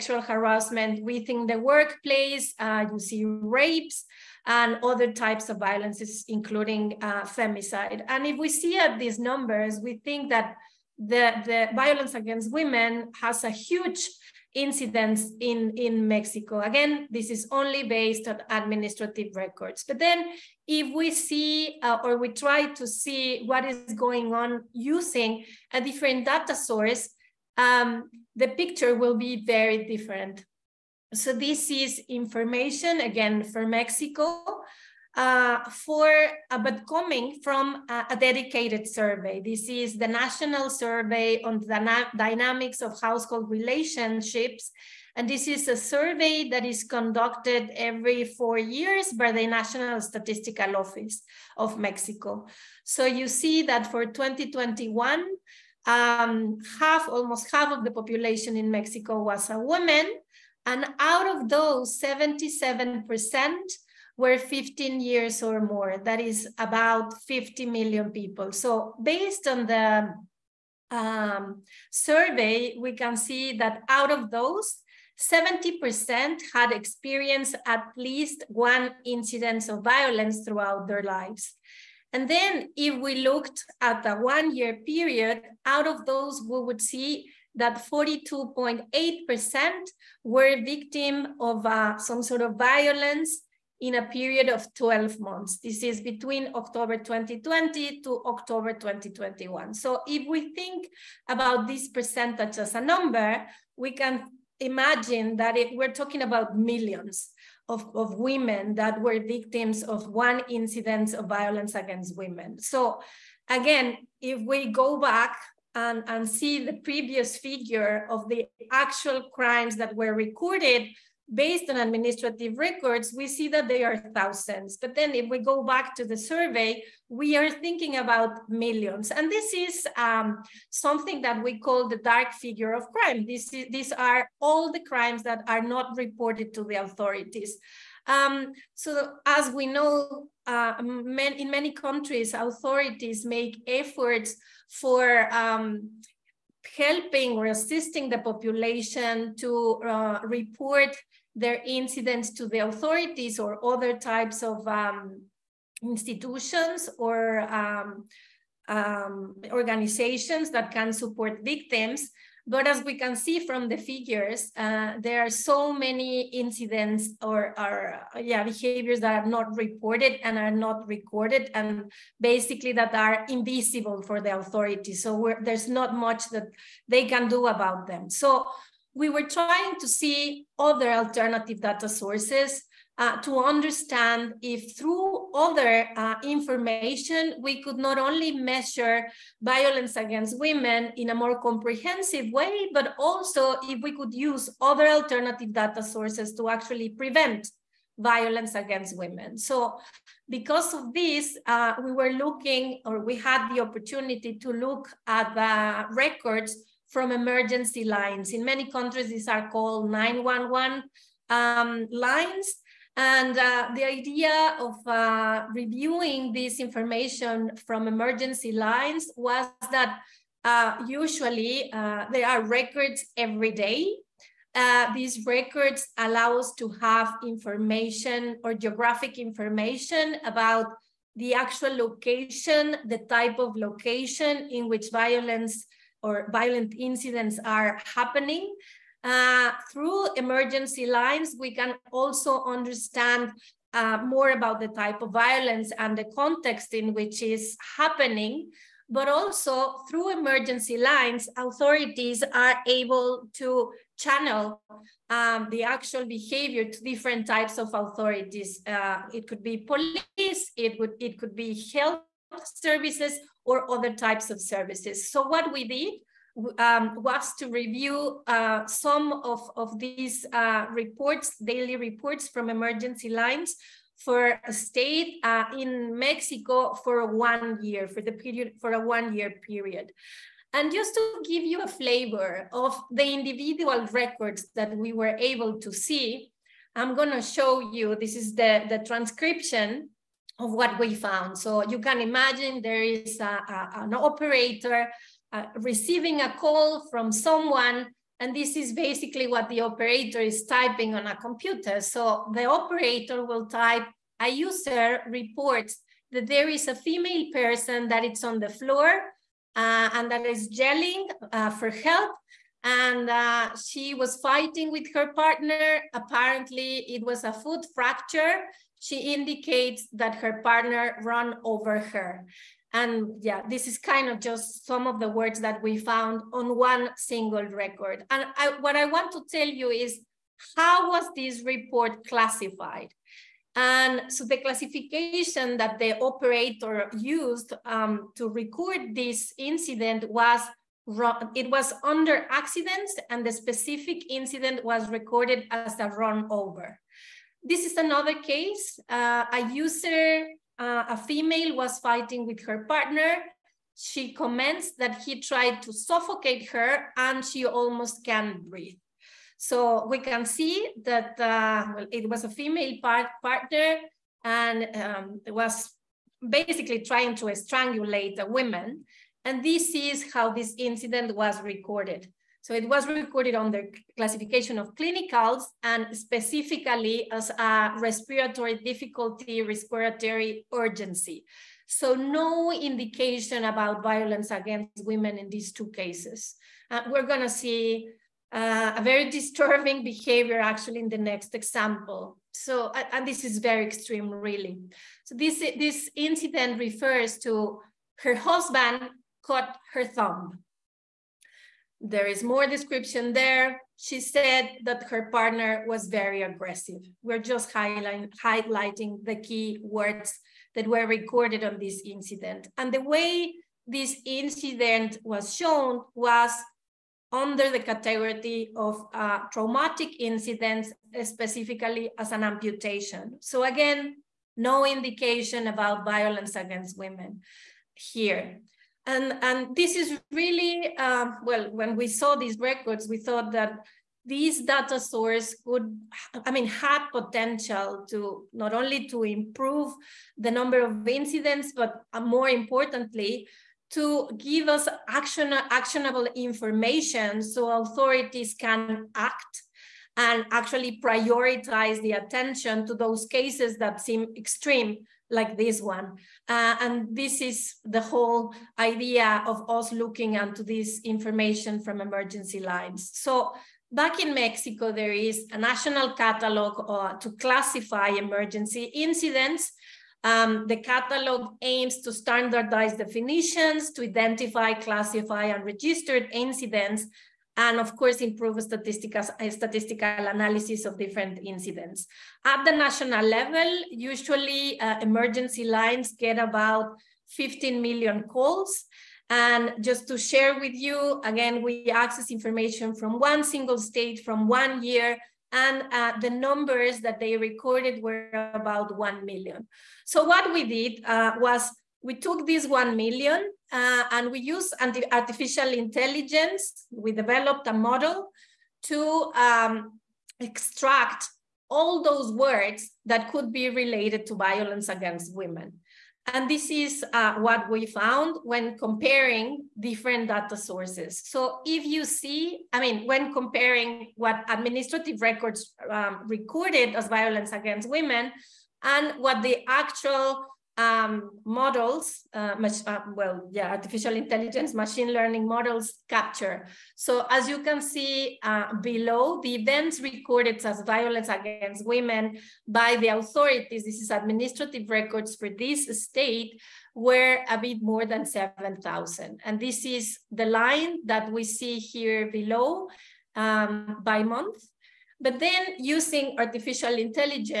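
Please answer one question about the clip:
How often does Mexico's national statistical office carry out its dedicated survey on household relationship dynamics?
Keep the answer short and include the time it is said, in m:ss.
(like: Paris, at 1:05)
every four years, at 0:47.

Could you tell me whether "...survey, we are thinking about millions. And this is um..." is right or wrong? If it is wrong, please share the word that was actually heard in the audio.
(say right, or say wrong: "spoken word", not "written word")
right.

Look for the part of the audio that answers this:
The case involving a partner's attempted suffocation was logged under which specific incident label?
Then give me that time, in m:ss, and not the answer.
6:19.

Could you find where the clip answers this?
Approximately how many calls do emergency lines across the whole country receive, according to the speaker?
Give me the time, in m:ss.
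8:07.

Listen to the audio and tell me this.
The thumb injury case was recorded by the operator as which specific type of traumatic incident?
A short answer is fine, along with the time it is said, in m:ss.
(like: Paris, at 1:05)
amputation, at 7:02.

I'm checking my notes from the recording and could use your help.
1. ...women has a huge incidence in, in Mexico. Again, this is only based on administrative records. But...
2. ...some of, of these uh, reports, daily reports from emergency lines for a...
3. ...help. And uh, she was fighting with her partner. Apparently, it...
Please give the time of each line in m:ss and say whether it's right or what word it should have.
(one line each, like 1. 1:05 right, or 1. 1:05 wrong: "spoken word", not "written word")
1. 0:12 right
2. 4:28 right
3. 5:11 right.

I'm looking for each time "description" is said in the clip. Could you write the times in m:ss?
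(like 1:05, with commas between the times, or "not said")
6:42.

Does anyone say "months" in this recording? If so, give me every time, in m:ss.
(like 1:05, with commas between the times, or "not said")
1:35, 9:14.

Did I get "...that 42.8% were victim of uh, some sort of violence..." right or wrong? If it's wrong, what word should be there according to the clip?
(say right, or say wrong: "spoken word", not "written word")
right.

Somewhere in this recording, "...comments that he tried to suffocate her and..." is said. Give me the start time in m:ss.
5:54.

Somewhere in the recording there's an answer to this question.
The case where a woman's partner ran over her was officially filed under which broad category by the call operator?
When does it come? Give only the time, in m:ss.
5:42.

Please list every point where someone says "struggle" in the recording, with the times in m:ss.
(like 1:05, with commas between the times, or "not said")
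not said.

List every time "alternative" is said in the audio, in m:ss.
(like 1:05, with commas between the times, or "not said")
3:00, 3:14.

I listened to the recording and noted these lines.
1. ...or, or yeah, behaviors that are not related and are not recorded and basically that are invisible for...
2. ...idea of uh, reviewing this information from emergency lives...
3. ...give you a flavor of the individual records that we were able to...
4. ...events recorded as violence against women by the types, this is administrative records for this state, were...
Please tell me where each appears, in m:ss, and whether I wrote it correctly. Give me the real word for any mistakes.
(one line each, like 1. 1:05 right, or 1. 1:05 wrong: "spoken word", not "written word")
1. 2:47 wrong: "reported", not "related"
2. 3:33 wrong: "lines", not "lives"
3. 4:41 right
4. 8:59 wrong: "authorities", not "types".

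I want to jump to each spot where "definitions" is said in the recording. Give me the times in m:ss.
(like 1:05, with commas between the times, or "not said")
7:52.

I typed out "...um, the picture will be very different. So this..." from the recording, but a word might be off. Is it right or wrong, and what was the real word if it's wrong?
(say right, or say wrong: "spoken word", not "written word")
right.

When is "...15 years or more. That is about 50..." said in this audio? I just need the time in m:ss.
1:04.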